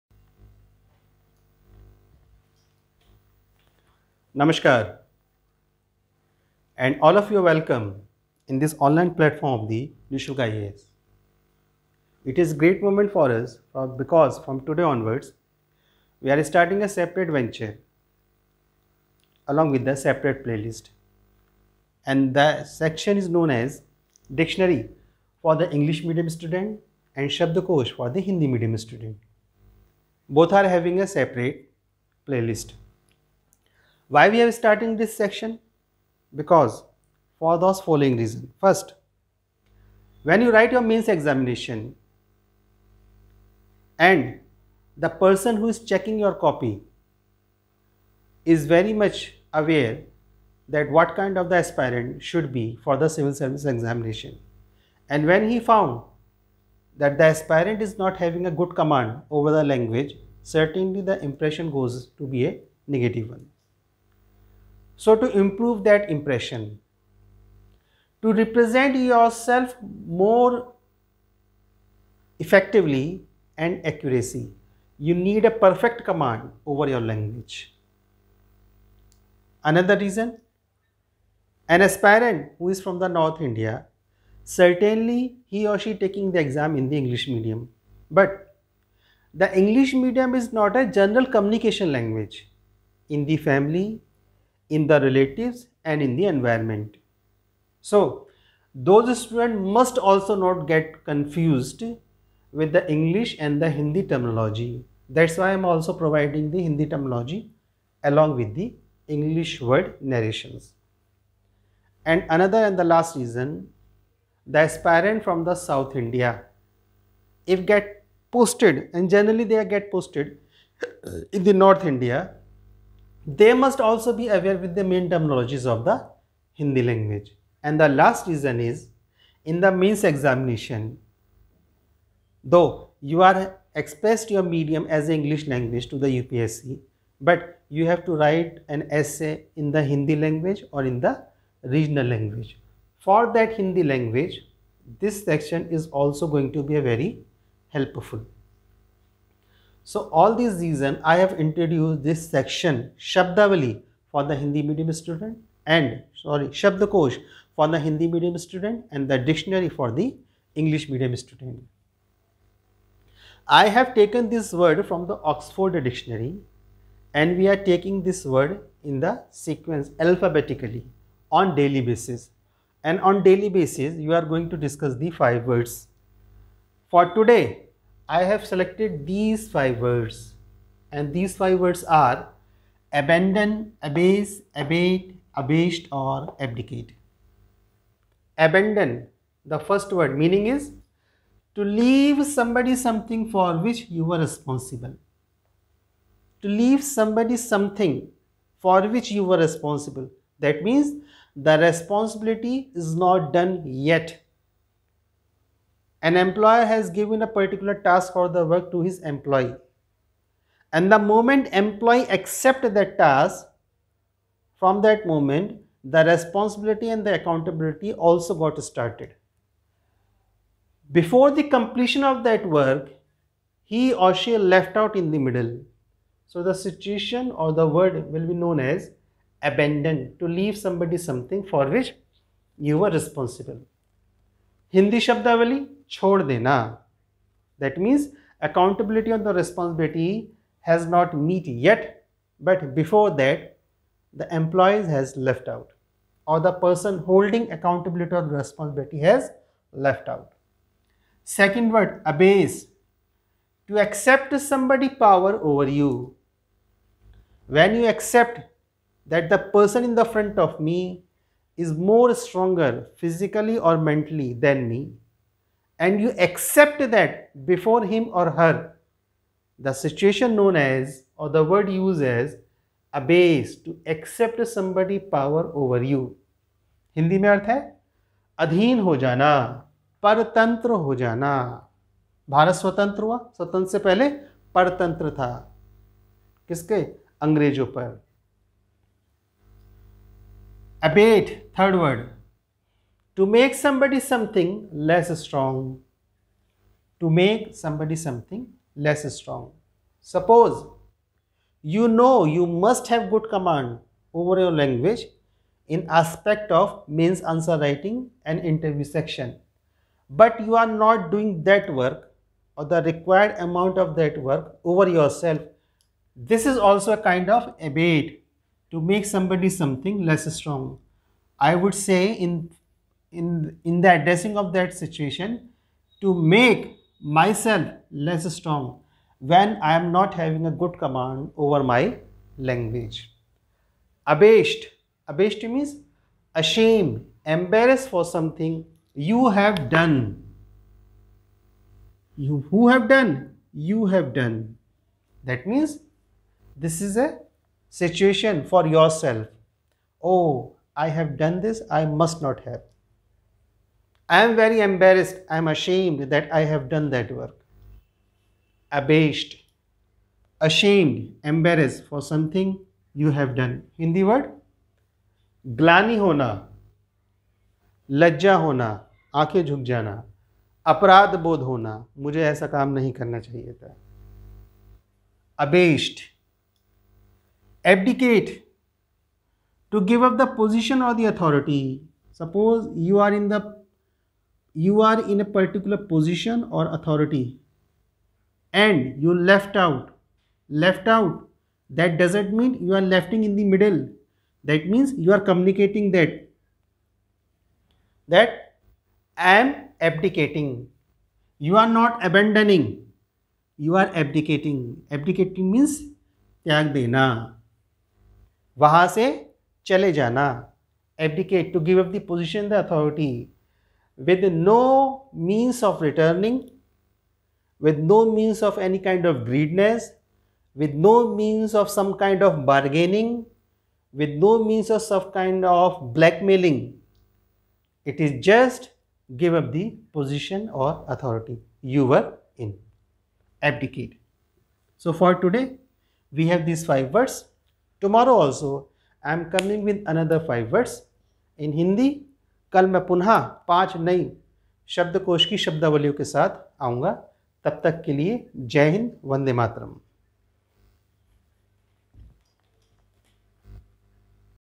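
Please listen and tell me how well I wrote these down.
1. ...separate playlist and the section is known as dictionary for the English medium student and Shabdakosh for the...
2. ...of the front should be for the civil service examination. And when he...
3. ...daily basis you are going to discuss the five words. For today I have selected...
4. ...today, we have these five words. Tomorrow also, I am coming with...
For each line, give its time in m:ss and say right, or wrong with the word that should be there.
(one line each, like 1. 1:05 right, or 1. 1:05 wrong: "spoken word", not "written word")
1. 0:19 right
2. 0:51 wrong: "aspirant", not "front"
3. 2:53 right
4. 7:15 right.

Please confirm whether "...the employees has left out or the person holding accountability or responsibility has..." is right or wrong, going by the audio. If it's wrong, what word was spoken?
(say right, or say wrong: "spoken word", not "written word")
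right.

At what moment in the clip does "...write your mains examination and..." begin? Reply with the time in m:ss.
0:40.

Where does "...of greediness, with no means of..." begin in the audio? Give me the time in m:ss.
6:59.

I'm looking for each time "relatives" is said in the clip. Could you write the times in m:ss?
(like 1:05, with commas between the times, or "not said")
1:35.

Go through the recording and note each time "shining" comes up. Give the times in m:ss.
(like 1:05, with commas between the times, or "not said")
not said.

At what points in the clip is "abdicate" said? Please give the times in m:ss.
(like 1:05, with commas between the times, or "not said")
3:06, 7:13.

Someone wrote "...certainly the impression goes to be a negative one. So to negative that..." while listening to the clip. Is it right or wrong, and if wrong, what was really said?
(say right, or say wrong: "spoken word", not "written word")
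wrong: "improve", not "negative".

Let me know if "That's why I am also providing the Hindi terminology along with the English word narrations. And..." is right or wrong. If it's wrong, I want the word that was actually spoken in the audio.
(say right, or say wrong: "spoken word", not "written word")
right.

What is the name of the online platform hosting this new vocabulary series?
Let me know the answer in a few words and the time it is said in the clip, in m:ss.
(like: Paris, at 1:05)
Nishulk IAS, at 0:10.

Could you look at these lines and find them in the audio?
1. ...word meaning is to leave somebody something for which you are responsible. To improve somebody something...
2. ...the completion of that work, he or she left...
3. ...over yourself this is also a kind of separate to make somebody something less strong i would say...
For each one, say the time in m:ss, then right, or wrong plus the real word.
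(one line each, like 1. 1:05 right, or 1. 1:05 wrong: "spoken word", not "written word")
1. 3:09 wrong: "leave", not "improve"
2. 3:41 right
3. 5:14 wrong: "abate", not "separate".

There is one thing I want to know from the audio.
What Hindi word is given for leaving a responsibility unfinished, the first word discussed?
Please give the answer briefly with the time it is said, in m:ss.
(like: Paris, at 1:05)
Chordena, at 3:55.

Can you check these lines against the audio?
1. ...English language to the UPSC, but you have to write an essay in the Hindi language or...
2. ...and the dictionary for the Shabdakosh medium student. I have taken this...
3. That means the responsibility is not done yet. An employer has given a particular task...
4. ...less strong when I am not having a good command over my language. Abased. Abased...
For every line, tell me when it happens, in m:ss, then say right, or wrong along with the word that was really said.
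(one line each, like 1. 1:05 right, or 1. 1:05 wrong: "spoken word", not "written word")
1. 2:15 right
2. 2:38 wrong: "English", not "Shabdakosh"
3. 3:20 right
4. 5:27 right.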